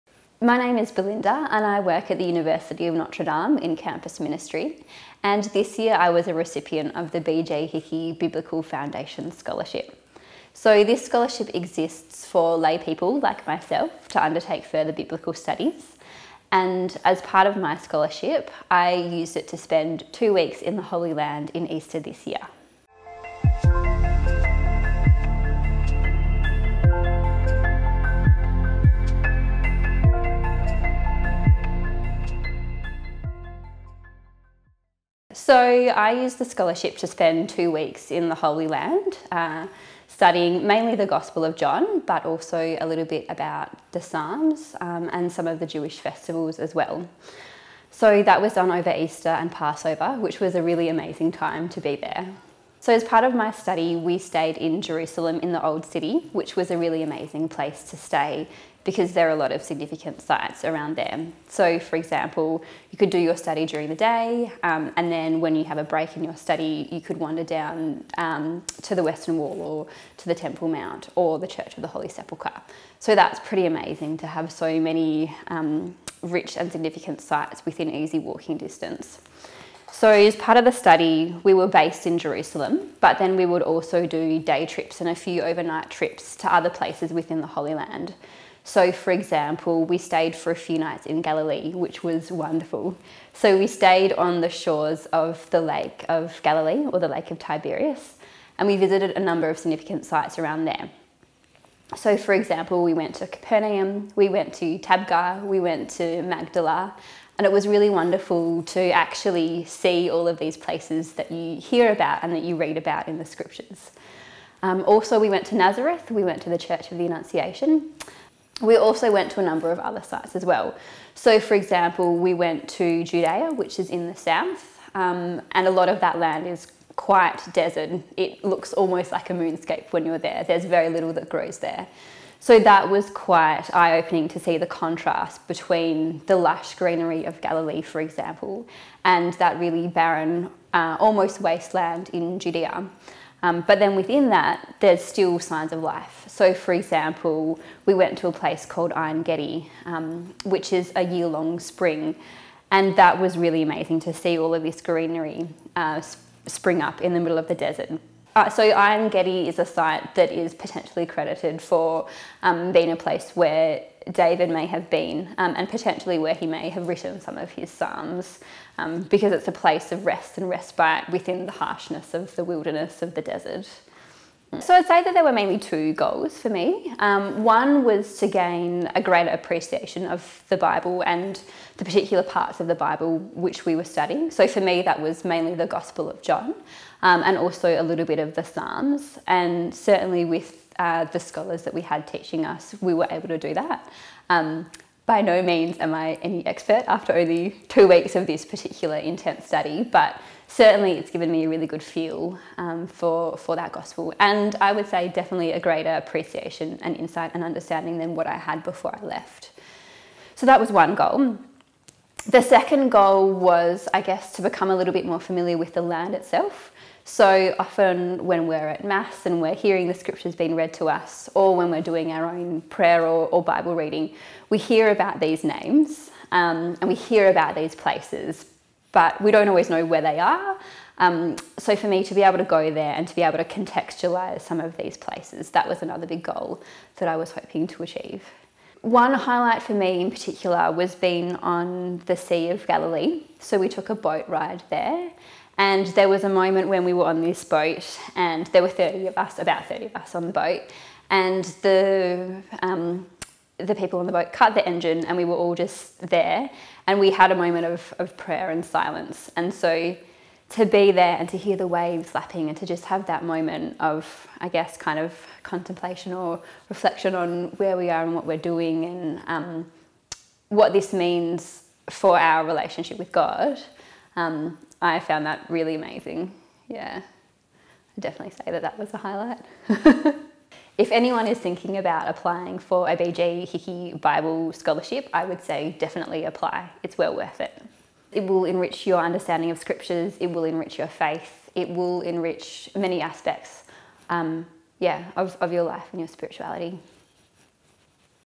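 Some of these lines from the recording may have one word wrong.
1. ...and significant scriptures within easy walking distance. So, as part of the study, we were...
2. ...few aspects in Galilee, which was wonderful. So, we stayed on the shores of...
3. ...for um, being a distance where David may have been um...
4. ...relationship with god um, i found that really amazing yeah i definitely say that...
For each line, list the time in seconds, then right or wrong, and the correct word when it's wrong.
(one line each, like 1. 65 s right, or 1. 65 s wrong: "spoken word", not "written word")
1. 76 s wrong: "sites", not "scriptures"
2. 90 s wrong: "nights", not "aspects"
3. 161 s wrong: "place", not "distance"
4. 272 s right.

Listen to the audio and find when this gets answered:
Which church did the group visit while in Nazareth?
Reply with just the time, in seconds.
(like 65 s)
116 s.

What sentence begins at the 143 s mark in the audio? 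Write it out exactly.
Um, but then within that, there's still signs of life.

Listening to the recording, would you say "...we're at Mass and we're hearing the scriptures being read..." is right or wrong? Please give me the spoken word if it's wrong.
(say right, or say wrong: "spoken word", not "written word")
right.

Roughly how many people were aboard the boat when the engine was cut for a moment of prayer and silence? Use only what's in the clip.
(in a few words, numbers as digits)
30.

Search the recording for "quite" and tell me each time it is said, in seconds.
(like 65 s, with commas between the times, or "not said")
126 s, 133 s.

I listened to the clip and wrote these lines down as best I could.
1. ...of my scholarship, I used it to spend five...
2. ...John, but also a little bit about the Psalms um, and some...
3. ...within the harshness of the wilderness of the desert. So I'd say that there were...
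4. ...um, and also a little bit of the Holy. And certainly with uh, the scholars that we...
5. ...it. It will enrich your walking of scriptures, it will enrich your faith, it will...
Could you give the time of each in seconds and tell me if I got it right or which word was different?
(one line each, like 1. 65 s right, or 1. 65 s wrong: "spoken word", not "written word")
1. 17 s wrong: "two", not "five"
2. 41 s right
3. 171 s right
4. 187 s wrong: "Psalms", not "Holy"
5. 287 s wrong: "understanding", not "walking".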